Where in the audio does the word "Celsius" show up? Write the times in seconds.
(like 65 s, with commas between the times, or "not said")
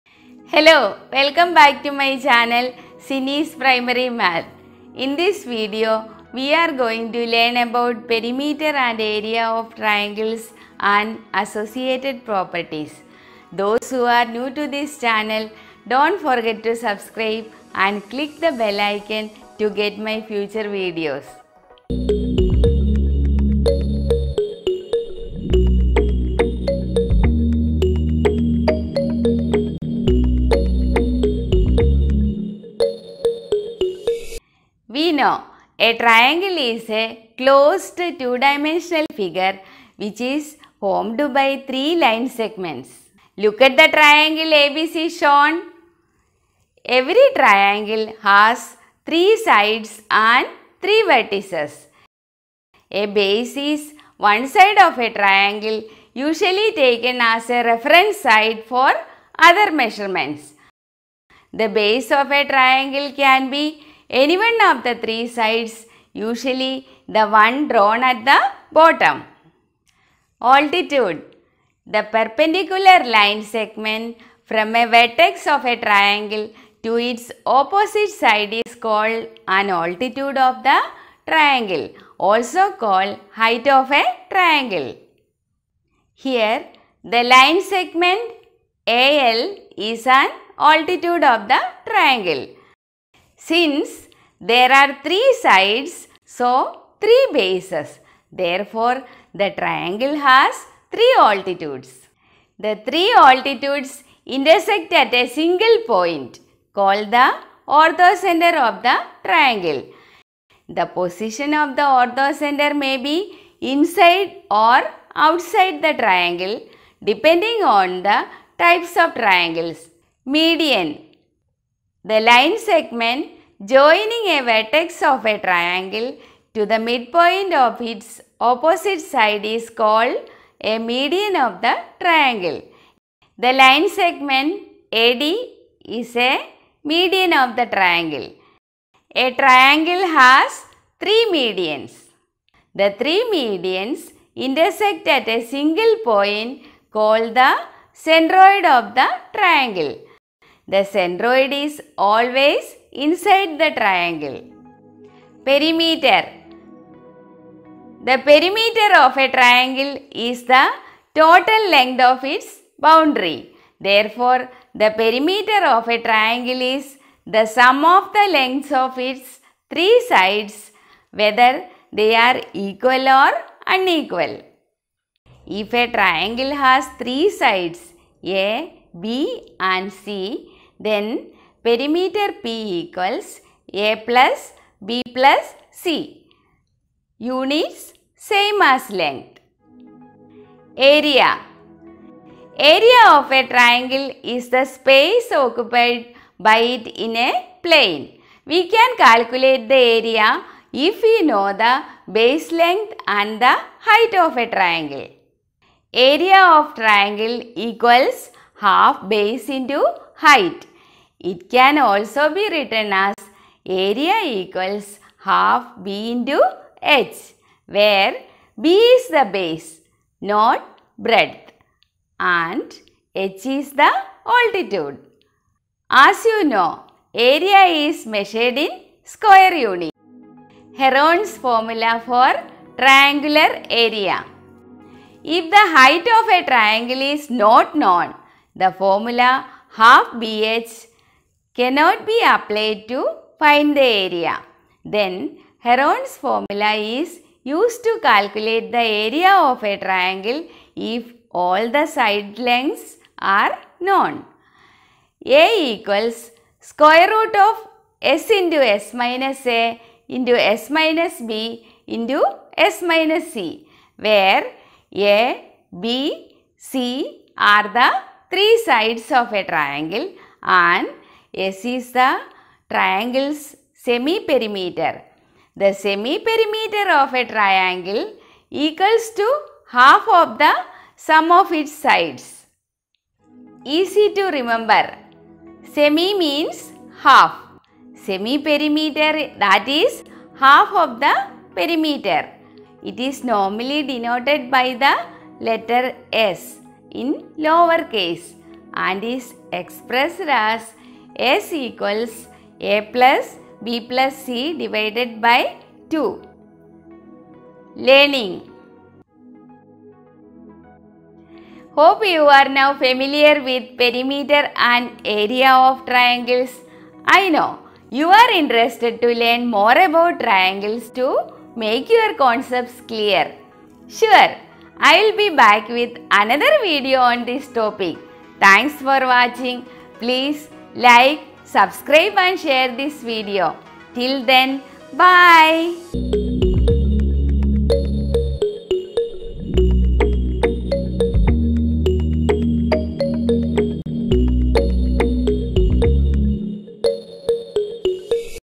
not said.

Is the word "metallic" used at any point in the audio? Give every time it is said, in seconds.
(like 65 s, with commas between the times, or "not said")
not said.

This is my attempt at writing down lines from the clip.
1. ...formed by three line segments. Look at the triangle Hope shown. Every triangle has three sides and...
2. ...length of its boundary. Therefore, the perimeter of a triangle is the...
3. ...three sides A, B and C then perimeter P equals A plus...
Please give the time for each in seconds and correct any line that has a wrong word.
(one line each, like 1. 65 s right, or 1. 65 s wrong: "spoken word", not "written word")
1. 40 s wrong: "ABC", not "Hope"
2. 161 s right
3. 177 s right.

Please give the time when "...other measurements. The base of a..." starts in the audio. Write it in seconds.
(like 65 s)
59 s.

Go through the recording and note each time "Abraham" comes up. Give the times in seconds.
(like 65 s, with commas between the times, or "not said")
not said.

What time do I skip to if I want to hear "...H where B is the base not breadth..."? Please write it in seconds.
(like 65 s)
216 s.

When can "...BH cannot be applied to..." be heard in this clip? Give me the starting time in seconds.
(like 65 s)
240 s.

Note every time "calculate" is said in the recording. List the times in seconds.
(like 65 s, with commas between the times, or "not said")
199 s, 248 s.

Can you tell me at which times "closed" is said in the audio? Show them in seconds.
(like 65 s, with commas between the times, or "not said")
37 s.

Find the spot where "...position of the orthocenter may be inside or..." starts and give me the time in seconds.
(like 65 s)
110 s.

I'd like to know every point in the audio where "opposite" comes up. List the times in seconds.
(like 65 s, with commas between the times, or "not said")
77 s, 128 s.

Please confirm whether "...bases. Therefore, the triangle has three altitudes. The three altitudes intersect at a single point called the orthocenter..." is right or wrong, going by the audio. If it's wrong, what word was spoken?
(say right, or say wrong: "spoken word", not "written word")
right.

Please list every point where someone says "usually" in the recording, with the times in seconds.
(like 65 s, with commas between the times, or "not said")
56 s, 66 s.